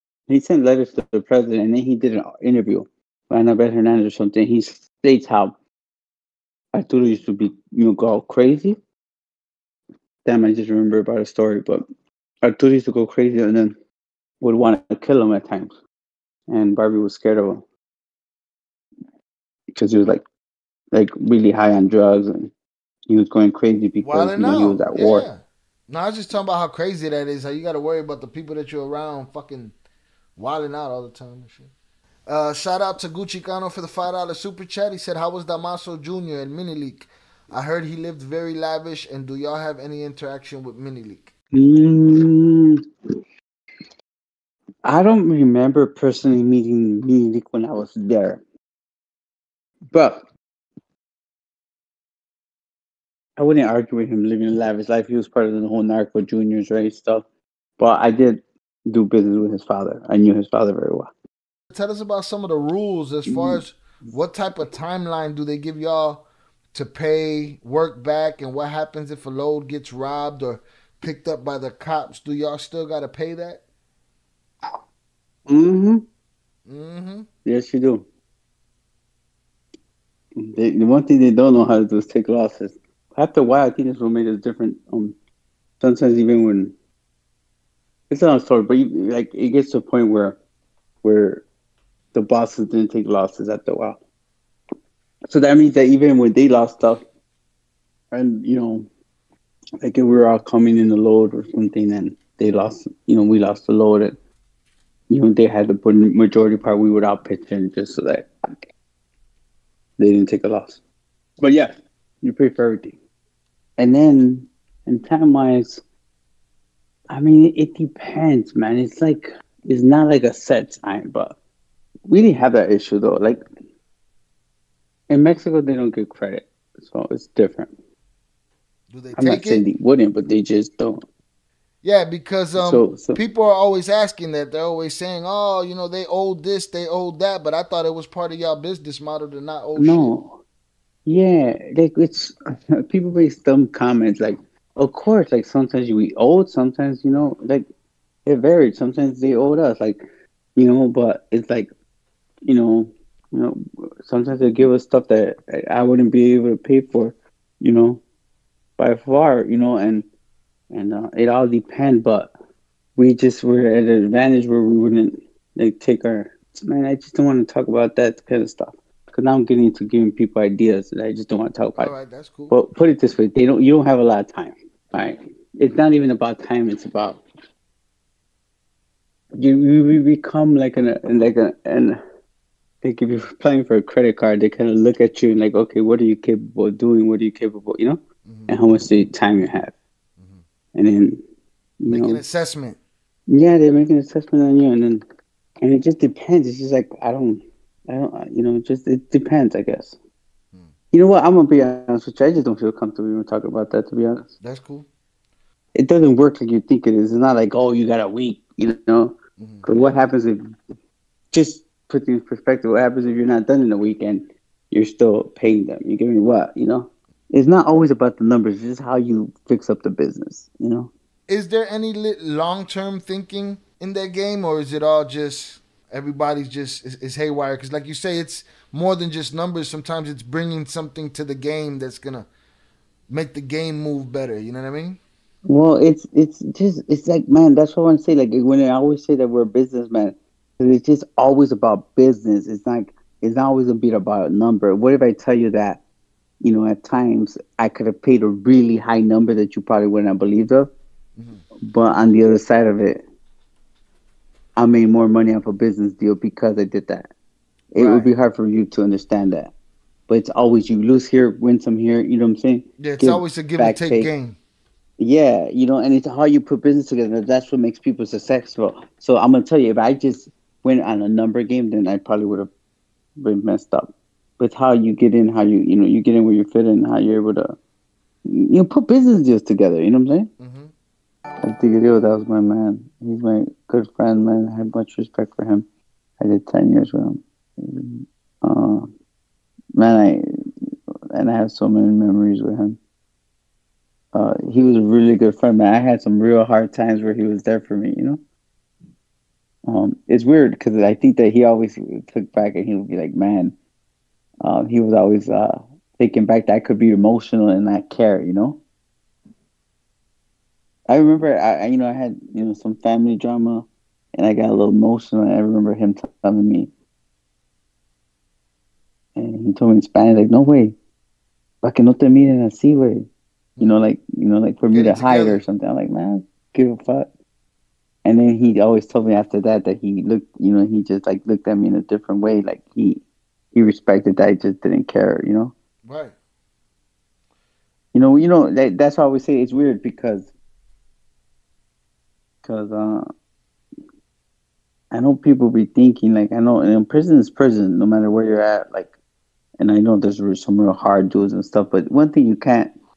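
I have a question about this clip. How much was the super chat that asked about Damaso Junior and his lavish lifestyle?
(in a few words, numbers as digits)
$5.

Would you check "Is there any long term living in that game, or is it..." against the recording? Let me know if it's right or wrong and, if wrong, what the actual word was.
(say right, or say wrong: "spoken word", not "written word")
wrong: "thinking", not "living".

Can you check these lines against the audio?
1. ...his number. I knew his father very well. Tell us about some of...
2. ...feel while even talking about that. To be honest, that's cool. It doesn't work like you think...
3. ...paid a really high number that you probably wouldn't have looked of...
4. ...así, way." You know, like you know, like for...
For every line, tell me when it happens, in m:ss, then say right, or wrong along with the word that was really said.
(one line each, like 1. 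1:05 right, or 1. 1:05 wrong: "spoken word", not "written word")
1. 0:59 wrong: "father", not "number"
2. 3:22 wrong: "comfortable", not "while"
3. 4:08 wrong: "believed", not "looked"
4. 5:22 right.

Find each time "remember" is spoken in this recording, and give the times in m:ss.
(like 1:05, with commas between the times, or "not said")
0:10, 0:45, 5:10, 5:15.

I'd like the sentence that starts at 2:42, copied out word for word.
But we just were at an advantage where we wouldn't like take our man.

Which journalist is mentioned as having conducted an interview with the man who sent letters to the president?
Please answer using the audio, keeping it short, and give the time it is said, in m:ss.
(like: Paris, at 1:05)
Anabel Hernandez, at 0:03.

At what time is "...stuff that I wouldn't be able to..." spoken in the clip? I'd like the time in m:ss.
2:34.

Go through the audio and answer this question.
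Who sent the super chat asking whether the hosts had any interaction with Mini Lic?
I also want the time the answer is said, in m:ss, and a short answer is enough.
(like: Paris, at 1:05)
Gucci Cano, at 0:33.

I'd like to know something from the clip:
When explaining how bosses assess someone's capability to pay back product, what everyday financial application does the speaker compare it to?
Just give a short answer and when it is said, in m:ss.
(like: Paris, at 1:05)
credit card, at 3:03.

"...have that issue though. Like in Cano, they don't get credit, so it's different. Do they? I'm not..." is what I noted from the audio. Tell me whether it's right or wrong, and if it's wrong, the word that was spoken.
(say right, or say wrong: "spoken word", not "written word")
wrong: "Mexico", not "Cano".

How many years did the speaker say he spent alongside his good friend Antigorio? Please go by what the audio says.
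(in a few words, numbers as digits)
10.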